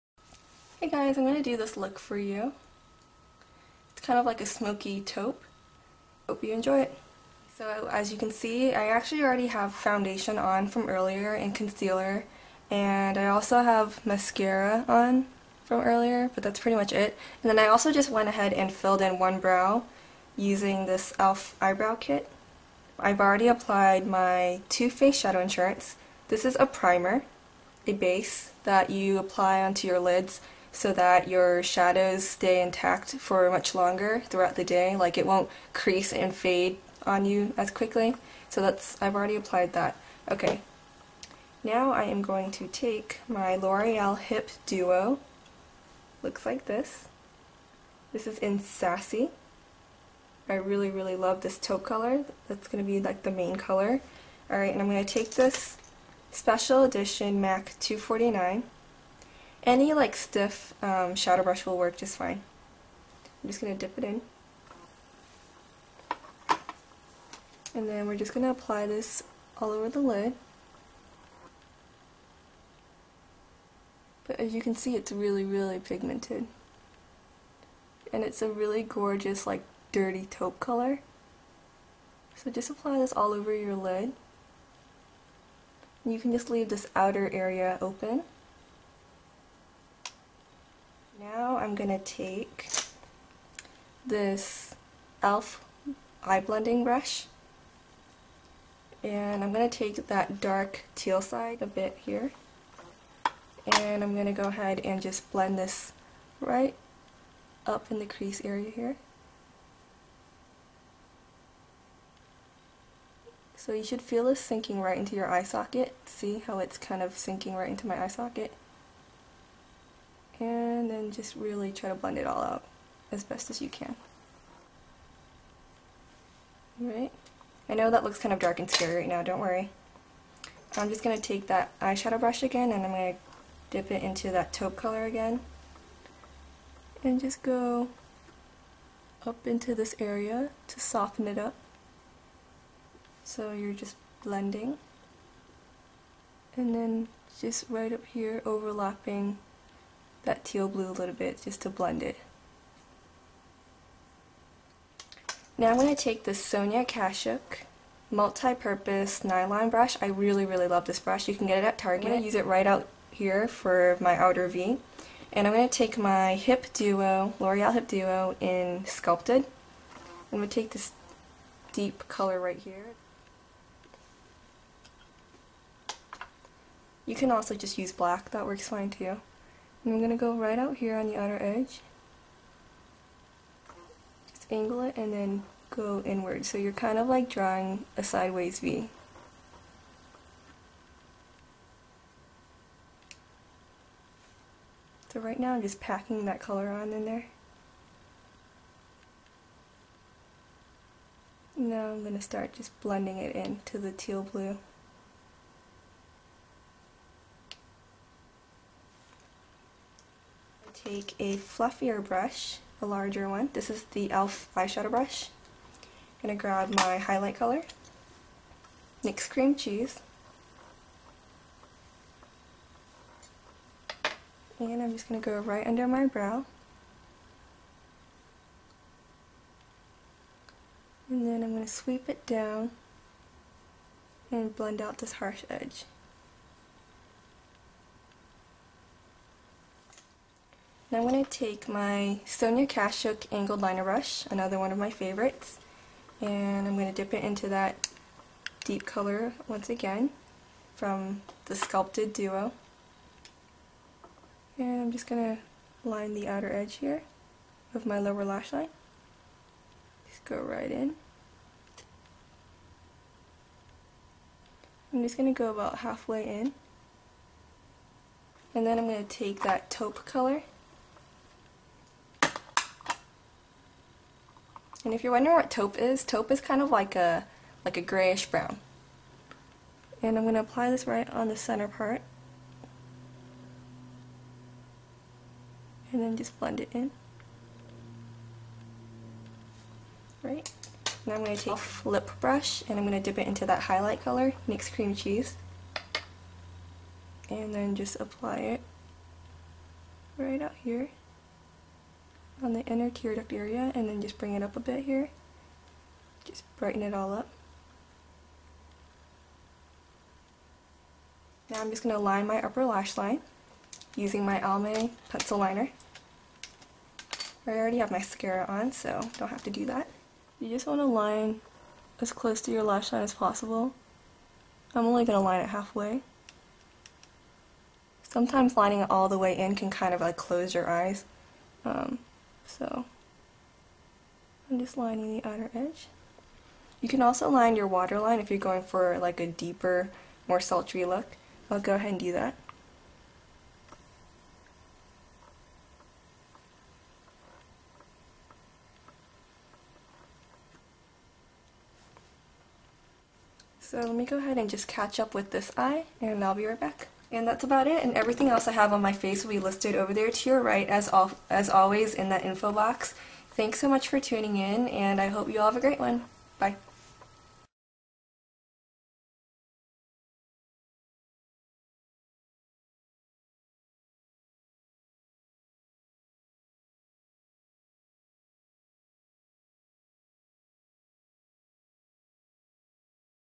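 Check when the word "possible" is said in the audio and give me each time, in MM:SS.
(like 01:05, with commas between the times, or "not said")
05:23.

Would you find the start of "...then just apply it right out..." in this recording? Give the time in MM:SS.
04:57.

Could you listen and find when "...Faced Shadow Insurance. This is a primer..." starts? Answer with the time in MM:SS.
00:24.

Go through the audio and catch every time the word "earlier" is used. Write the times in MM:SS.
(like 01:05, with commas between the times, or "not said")
00:10, 00:15.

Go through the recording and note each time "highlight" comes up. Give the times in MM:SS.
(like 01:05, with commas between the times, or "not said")
03:36, 04:53.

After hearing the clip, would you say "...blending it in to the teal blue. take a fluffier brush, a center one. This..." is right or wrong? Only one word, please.
wrong.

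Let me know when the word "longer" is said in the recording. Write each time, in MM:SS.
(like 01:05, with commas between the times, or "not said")
00:33.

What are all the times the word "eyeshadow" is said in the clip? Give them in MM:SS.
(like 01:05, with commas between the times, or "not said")
02:11, 03:34.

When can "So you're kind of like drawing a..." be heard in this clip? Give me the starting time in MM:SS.
03:06.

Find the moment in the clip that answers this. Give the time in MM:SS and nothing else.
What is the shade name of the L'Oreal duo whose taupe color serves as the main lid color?
00:48.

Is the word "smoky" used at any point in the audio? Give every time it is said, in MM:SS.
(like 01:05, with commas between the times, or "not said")
00:04.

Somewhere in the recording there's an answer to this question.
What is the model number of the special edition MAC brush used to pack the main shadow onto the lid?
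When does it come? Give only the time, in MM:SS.
00:57.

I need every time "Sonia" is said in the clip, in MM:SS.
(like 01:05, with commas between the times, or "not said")
02:36, 04:02.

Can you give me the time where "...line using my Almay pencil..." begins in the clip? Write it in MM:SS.
05:12.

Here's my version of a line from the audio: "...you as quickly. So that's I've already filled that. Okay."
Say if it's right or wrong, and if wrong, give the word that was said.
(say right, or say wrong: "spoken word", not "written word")
wrong: "applied", not "filled".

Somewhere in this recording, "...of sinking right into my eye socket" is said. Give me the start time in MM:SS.
01:57.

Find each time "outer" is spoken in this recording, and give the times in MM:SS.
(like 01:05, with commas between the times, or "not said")
01:26, 02:44, 03:01, 04:16, 05:35.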